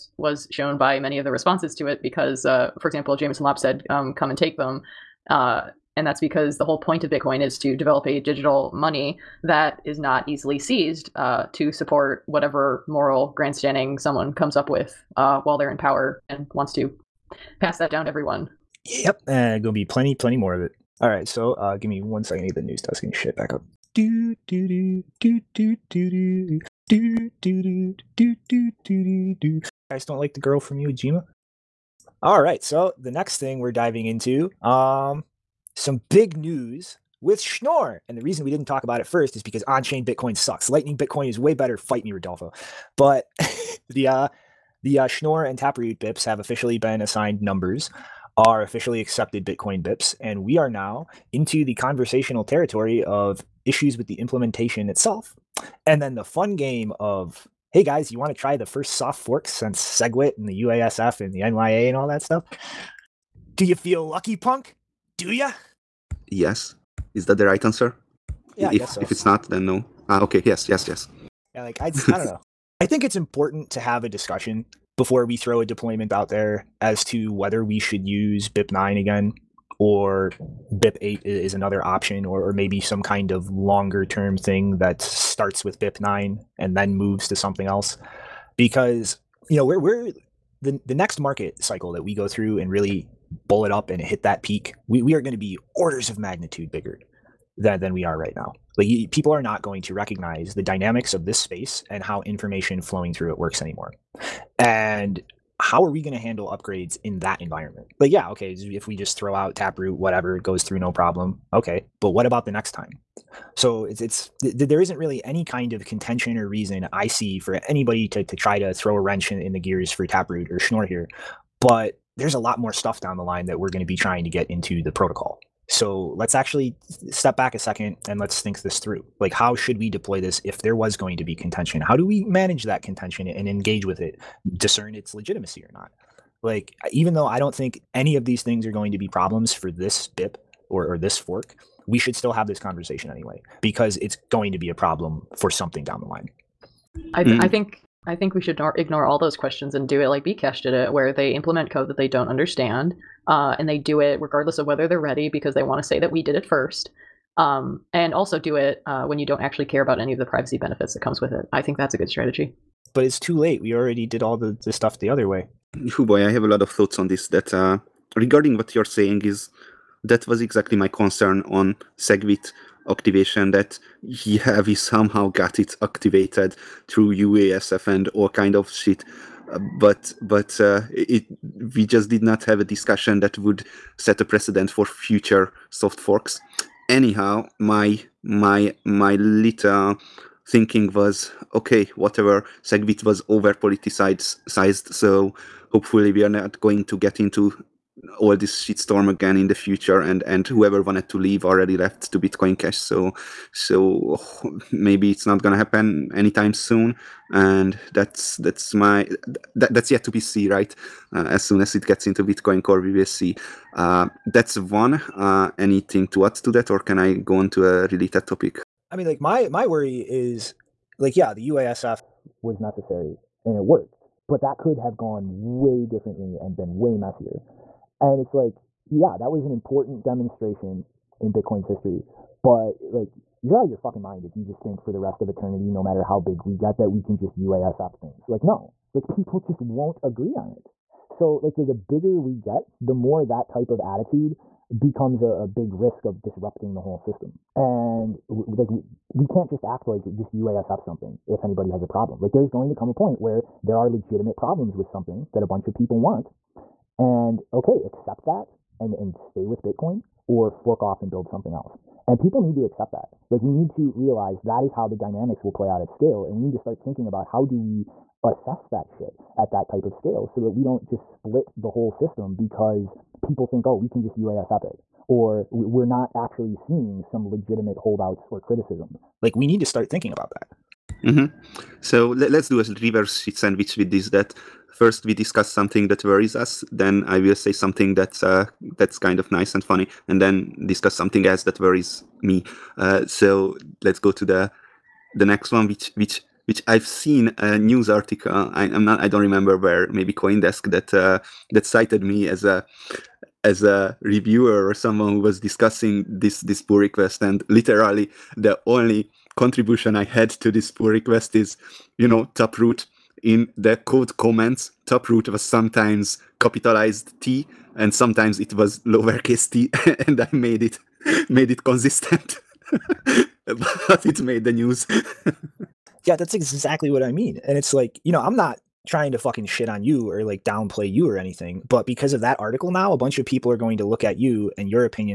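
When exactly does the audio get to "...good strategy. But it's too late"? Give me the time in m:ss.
2:41.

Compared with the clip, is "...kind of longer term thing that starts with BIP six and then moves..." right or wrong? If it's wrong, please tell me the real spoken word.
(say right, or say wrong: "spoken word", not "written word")
wrong: "nine", not "six".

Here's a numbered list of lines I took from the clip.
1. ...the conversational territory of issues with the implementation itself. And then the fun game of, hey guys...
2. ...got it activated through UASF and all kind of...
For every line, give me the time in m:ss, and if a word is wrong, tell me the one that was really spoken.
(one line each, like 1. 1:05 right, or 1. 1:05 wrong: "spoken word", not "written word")
1. 0:51 right
2. 2:55 right.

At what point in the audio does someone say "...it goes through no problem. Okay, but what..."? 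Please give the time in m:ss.
1:50.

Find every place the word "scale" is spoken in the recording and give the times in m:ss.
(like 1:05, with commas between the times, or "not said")
4:25, 4:29.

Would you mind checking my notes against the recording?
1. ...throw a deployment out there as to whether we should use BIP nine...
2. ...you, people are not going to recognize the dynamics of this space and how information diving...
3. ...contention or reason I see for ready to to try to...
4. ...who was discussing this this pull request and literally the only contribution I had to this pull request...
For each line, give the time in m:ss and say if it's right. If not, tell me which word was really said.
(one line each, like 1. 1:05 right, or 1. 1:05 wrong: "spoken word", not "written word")
1. 1:15 right
2. 1:38 wrong: "flowing", not "diving"
3. 1:55 wrong: "anybody", not "ready"
4. 5:05 right.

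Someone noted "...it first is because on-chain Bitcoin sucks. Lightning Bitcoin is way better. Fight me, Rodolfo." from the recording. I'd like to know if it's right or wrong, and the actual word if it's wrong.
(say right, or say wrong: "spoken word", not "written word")
right.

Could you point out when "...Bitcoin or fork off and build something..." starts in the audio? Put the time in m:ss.
4:19.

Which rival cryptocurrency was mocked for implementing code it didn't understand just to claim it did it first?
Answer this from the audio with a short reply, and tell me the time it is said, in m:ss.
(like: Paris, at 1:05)
Bcash, at 2:30.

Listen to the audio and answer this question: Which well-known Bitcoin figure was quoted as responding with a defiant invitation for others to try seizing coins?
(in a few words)
Jameson Lopp.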